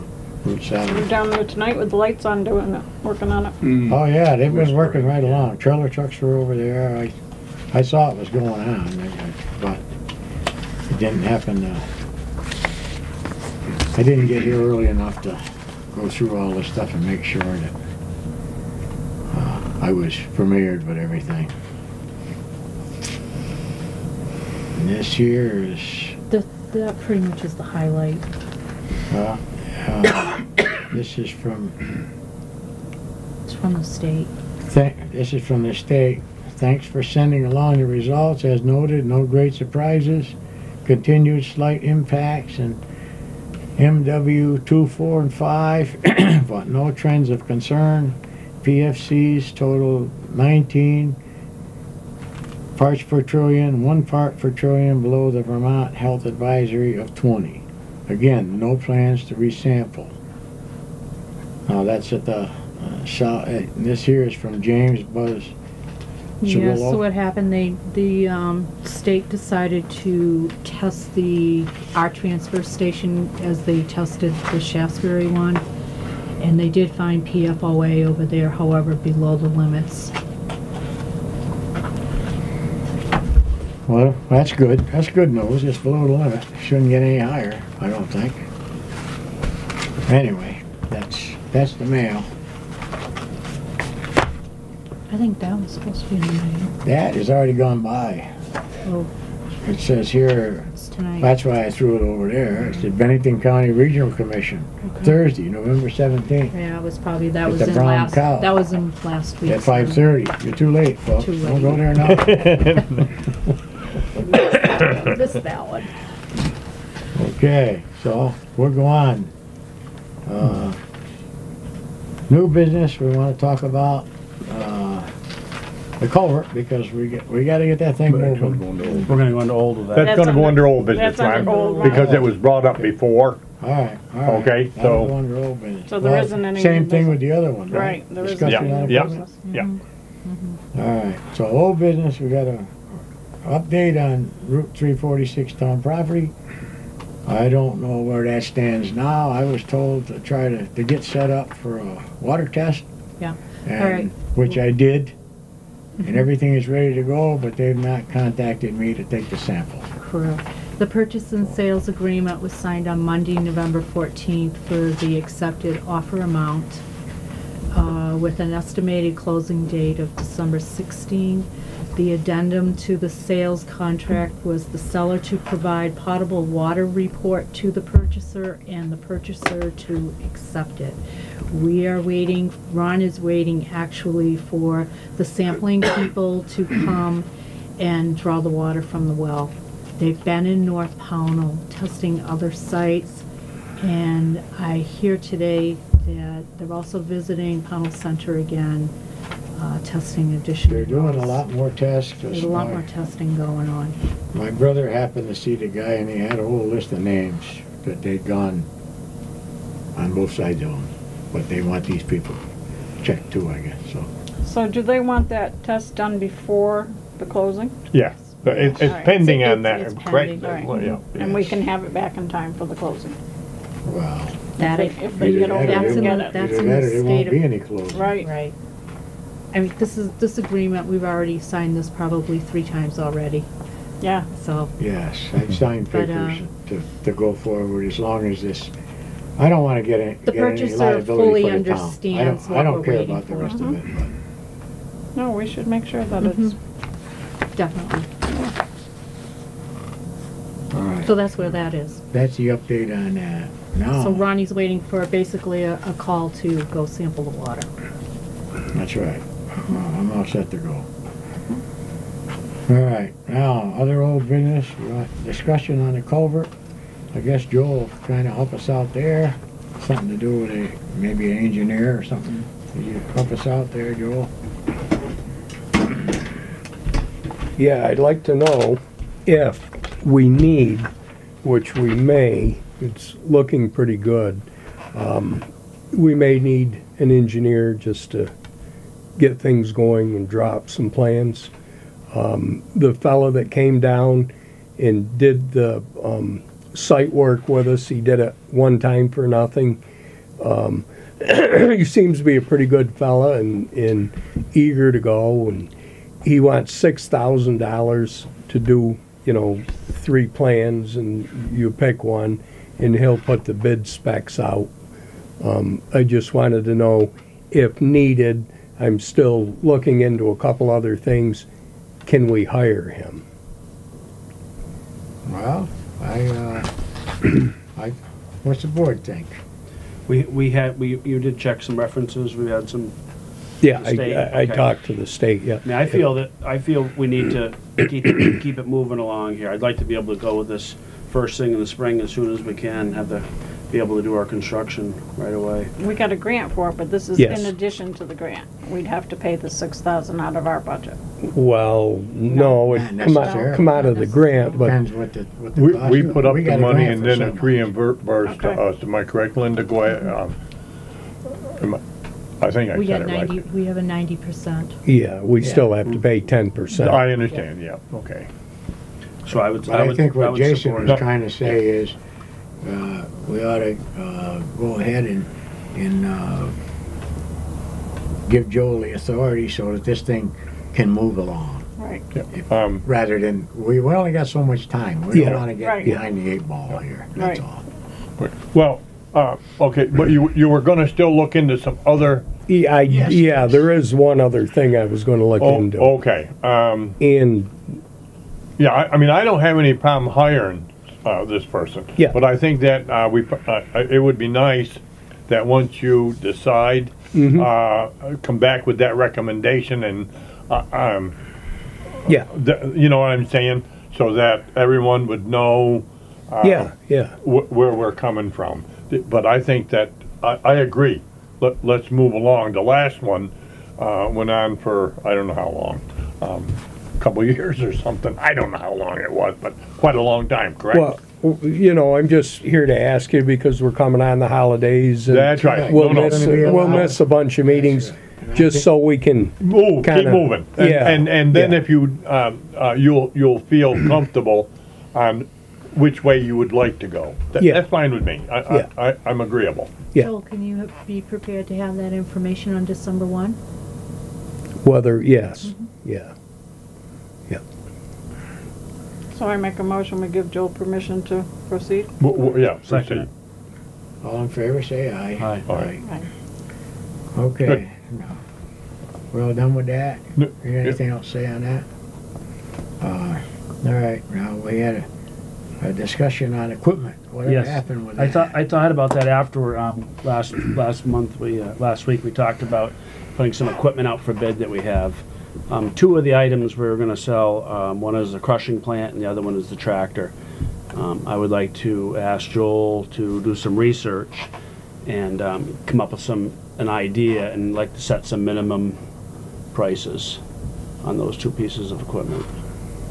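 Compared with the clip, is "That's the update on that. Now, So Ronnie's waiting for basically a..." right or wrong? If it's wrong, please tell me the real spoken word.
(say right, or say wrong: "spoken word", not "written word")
right.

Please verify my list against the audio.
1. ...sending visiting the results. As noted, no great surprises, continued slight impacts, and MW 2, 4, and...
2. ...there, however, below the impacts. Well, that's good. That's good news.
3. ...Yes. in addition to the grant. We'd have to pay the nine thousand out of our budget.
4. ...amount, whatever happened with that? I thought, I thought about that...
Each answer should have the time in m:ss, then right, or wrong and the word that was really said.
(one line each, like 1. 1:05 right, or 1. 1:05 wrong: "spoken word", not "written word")
1. 0:37 wrong: "along", not "visiting"
2. 1:18 wrong: "limits", not "impacts"
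3. 5:47 wrong: "six", not "nine"
4. 7:56 wrong: "equipment", not "amount".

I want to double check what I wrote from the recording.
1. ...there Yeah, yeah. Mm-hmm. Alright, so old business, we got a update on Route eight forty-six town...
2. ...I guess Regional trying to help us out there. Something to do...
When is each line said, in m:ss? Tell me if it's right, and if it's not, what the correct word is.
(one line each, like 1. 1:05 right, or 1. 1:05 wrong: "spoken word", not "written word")
1. 2:18 wrong: "three", not "eight"
2. 4:27 wrong: "Joel", not "Regional".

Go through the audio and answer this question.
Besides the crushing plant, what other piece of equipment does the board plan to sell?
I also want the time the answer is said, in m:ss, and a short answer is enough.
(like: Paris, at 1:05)
tractor, at 8:09.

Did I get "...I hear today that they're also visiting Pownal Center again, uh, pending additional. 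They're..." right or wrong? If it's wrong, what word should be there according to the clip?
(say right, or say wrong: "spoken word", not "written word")
wrong: "testing", not "pending".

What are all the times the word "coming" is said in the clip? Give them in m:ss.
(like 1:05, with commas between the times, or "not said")
6:57, 7:13.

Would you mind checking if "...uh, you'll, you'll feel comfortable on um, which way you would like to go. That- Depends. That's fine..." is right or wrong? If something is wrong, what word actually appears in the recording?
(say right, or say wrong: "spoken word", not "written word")
wrong: "Yeah", not "Depends".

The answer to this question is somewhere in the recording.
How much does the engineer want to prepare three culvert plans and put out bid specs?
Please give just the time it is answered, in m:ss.
5:06.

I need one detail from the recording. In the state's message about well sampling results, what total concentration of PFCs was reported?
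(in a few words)
19 parts per trillion.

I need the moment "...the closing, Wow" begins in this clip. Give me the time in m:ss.
3:42.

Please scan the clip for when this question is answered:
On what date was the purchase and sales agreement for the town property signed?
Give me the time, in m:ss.
2:43.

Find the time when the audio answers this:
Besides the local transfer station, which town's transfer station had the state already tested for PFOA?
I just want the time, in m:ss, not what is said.
1:14.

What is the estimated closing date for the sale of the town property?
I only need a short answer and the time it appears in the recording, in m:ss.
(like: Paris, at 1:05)
December 16, at 2:50.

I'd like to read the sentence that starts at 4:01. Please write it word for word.
I understands don't, I we're don't care about the rest of it, but.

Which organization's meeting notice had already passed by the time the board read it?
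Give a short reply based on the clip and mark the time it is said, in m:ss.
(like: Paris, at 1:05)
Bennington County Regional Commission, at 1:42.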